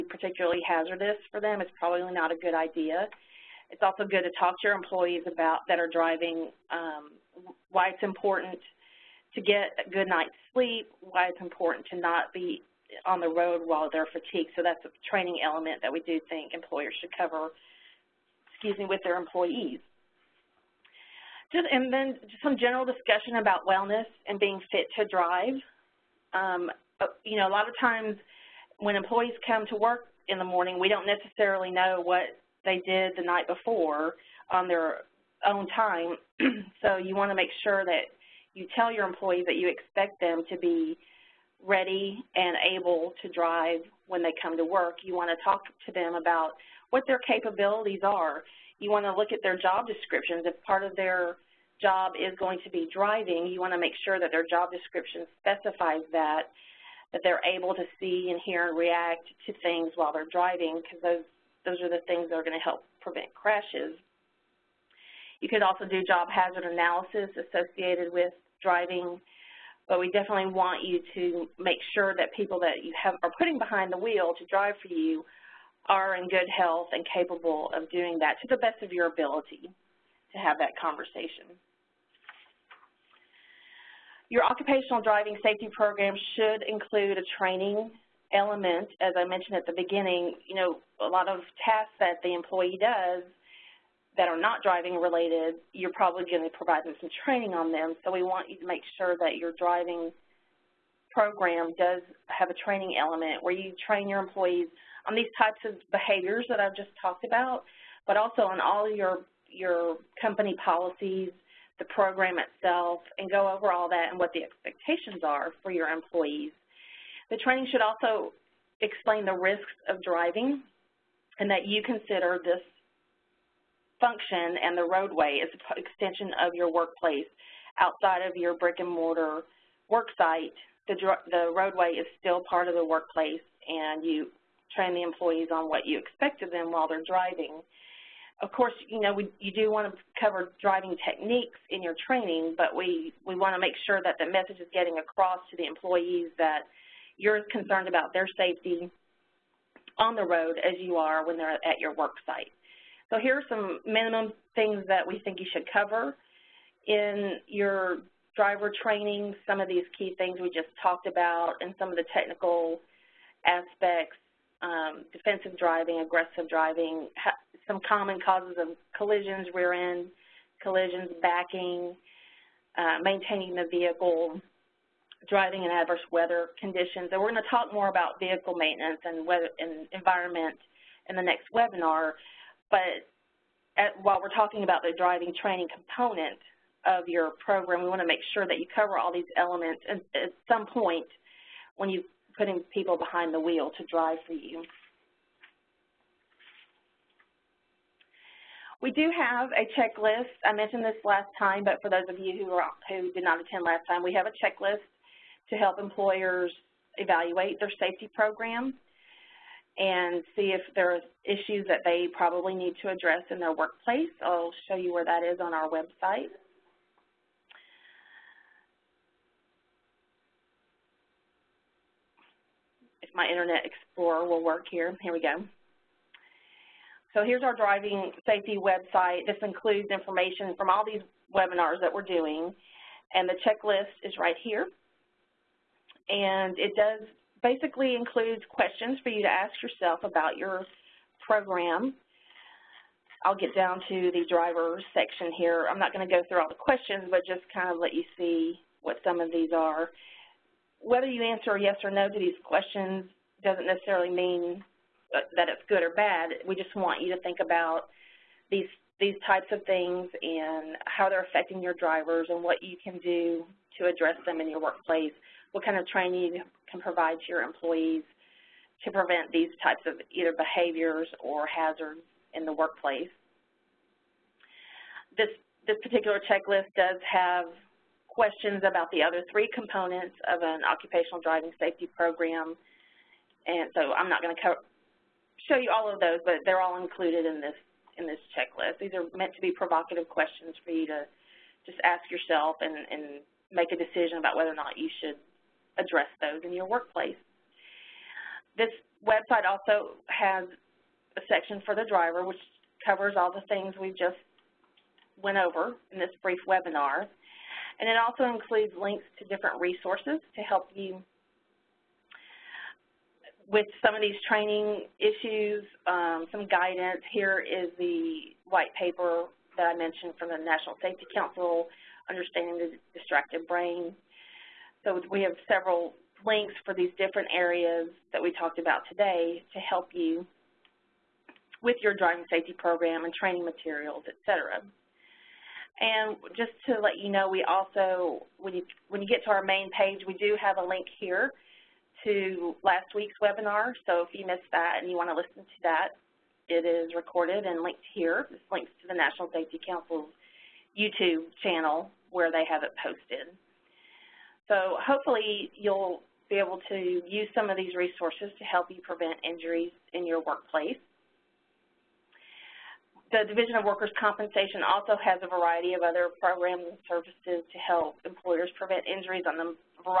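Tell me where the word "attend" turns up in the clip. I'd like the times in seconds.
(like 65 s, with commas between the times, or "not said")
203 s.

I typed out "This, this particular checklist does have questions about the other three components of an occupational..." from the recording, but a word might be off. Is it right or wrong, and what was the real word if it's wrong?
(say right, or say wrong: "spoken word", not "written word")
right.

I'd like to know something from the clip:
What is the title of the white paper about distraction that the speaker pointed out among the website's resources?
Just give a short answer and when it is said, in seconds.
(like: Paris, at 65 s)
Understanding the Distracted Brain, at 322 s.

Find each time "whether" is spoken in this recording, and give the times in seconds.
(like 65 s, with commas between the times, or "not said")
250 s, 294 s.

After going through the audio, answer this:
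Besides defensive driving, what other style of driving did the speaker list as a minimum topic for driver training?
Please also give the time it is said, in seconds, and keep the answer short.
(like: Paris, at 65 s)
aggressive driving, at 165 s.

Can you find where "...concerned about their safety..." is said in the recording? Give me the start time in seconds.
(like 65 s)
147 s.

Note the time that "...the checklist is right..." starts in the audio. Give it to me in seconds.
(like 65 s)
233 s.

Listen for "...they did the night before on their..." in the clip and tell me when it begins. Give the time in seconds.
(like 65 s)
32 s.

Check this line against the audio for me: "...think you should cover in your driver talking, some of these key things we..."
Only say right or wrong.
wrong.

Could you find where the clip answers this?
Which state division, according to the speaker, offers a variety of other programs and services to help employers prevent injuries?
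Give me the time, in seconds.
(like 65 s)
363 s.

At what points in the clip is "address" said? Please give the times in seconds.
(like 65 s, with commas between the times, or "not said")
212 s, 263 s, 295 s.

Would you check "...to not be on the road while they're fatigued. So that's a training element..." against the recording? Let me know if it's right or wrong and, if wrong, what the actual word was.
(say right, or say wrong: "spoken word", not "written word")
right.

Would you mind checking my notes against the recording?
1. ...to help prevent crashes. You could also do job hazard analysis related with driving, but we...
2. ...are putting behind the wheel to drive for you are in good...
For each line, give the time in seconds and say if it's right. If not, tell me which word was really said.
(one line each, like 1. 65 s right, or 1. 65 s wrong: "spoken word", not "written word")
1. 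62 s wrong: "associated", not "related"
2. 73 s right.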